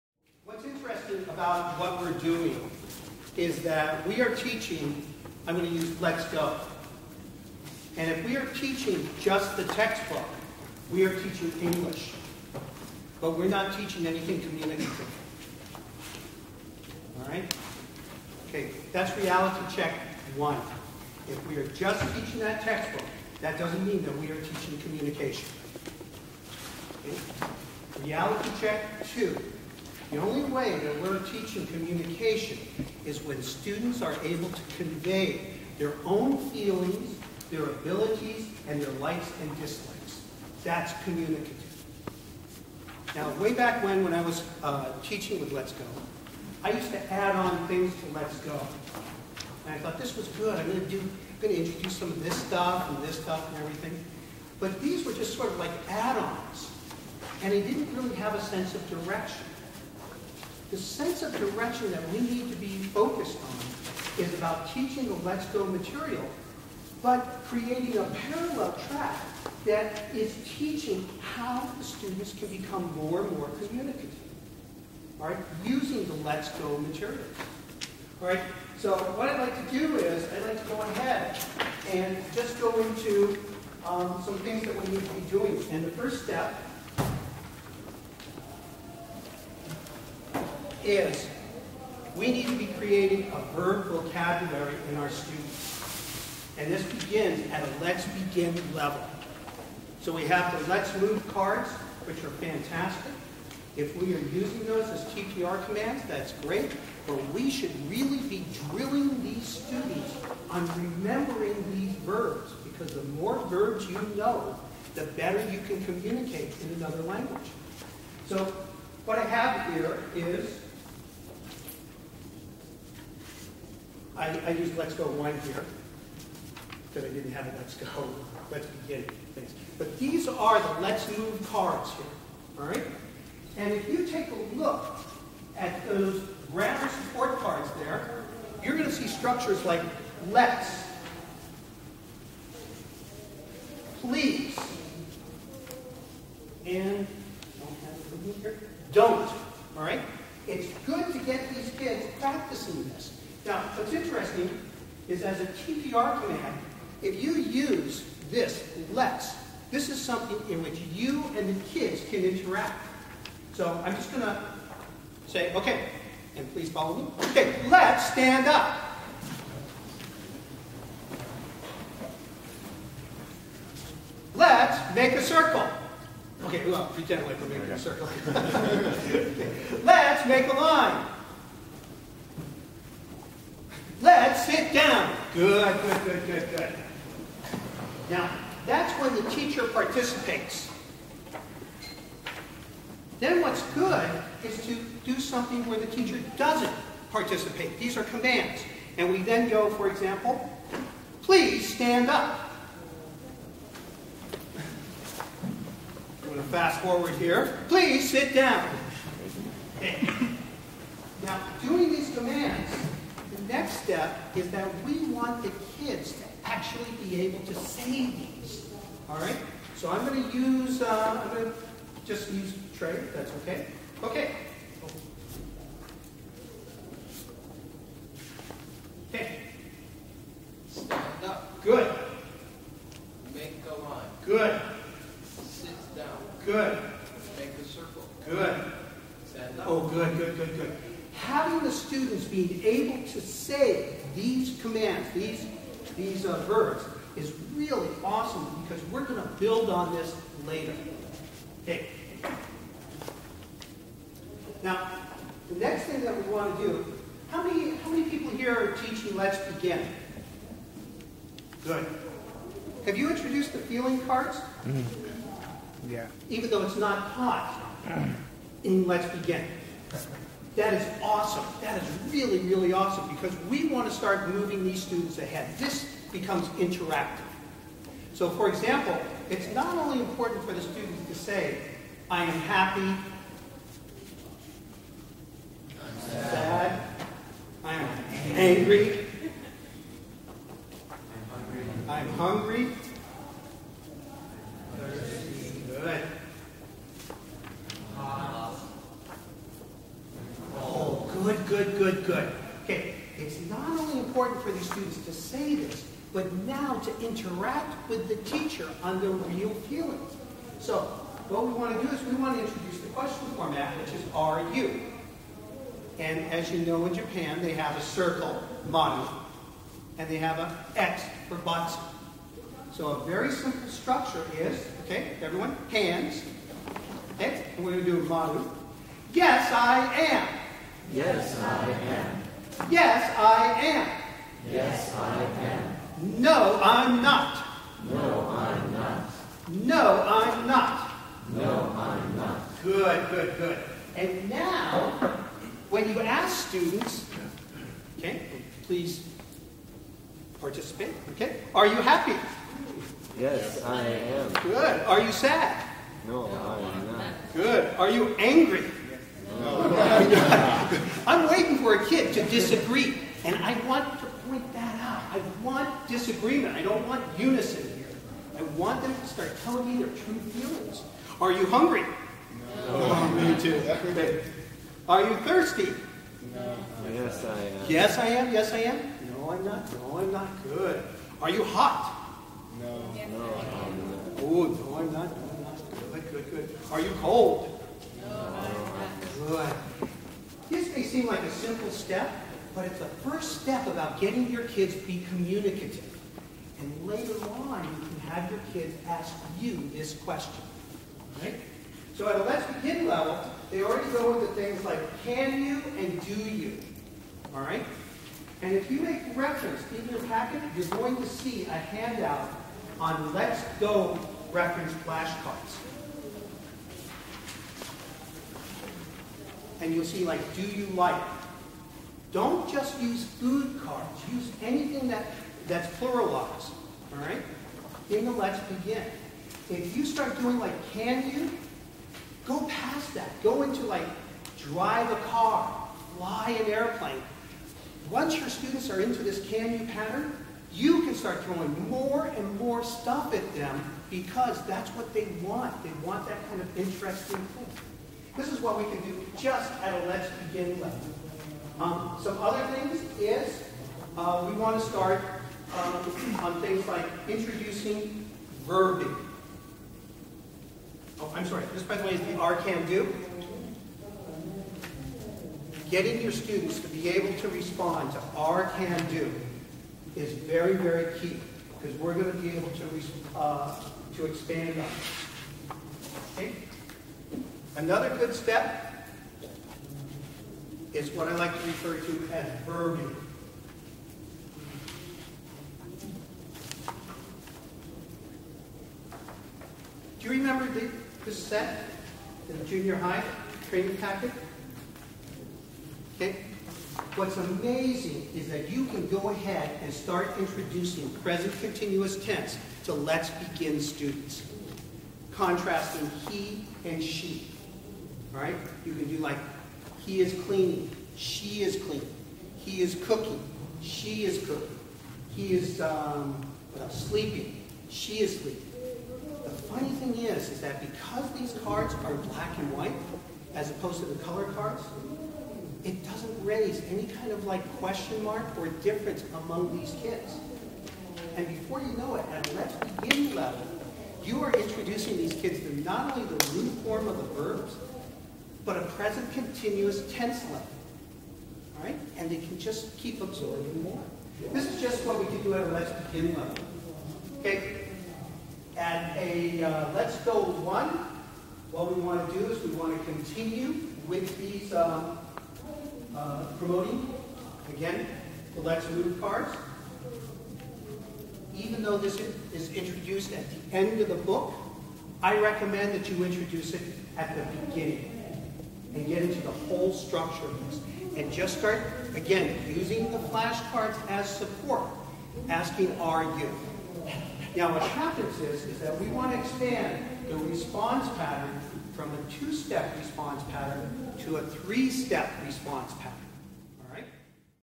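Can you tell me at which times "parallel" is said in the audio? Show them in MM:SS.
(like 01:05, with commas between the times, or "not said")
01:08.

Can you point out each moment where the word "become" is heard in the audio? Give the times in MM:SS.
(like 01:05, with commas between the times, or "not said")
01:12, 04:36.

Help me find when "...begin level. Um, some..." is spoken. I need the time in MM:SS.
07:30.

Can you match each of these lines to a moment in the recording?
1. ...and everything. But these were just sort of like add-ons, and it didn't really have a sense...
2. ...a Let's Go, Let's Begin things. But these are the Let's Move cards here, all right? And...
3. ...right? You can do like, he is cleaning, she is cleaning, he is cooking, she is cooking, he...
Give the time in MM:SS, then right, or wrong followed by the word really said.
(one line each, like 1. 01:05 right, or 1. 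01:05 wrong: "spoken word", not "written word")
1. 00:53 right
2. 02:07 right
3. 08:28 right.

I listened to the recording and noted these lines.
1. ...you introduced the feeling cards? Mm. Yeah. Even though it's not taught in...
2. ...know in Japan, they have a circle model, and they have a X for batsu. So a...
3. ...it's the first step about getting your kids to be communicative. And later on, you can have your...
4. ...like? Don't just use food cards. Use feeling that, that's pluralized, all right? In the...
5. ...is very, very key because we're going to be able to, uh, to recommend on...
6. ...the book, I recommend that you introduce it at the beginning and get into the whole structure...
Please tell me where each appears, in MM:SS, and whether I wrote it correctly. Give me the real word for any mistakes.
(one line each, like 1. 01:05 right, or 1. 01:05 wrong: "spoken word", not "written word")
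1. 04:22 right
2. 05:16 right
3. 06:32 right
4. 07:00 wrong: "anything", not "feeling"
5. 07:49 wrong: "expand", not "recommend"
6. 09:23 right.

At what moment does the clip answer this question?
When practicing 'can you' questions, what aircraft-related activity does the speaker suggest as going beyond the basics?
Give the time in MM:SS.
07:15.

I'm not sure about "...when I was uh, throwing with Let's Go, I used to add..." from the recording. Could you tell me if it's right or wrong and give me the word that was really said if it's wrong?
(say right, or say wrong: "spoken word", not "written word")
wrong: "teaching", not "throwing".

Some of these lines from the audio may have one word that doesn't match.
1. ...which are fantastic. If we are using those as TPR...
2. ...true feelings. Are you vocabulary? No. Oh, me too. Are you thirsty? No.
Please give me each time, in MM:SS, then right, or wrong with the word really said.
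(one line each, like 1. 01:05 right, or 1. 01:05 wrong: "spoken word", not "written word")
1. 01:42 right
2. 06:09 wrong: "hungry", not "vocabulary".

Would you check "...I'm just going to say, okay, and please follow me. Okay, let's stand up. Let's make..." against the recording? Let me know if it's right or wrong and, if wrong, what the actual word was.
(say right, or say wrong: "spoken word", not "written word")
right.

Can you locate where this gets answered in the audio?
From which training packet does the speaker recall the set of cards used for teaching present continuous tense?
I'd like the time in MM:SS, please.
08:12.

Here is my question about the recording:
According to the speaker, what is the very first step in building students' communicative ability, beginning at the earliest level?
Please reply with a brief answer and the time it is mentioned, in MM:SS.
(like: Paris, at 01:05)
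verb vocabulary, at 01:33.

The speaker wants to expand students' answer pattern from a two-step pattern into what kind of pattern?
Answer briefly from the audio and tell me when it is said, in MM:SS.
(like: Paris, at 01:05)
three-step response pattern, at 09:44.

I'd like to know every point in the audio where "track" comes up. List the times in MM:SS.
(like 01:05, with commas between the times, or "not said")
01:08.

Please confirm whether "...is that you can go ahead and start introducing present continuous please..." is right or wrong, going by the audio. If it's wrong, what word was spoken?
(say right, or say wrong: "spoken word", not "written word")
wrong: "tense", not "please".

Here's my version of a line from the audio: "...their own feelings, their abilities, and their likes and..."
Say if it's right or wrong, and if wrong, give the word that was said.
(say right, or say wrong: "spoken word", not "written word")
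right.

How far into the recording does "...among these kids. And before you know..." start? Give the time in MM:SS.
08:49.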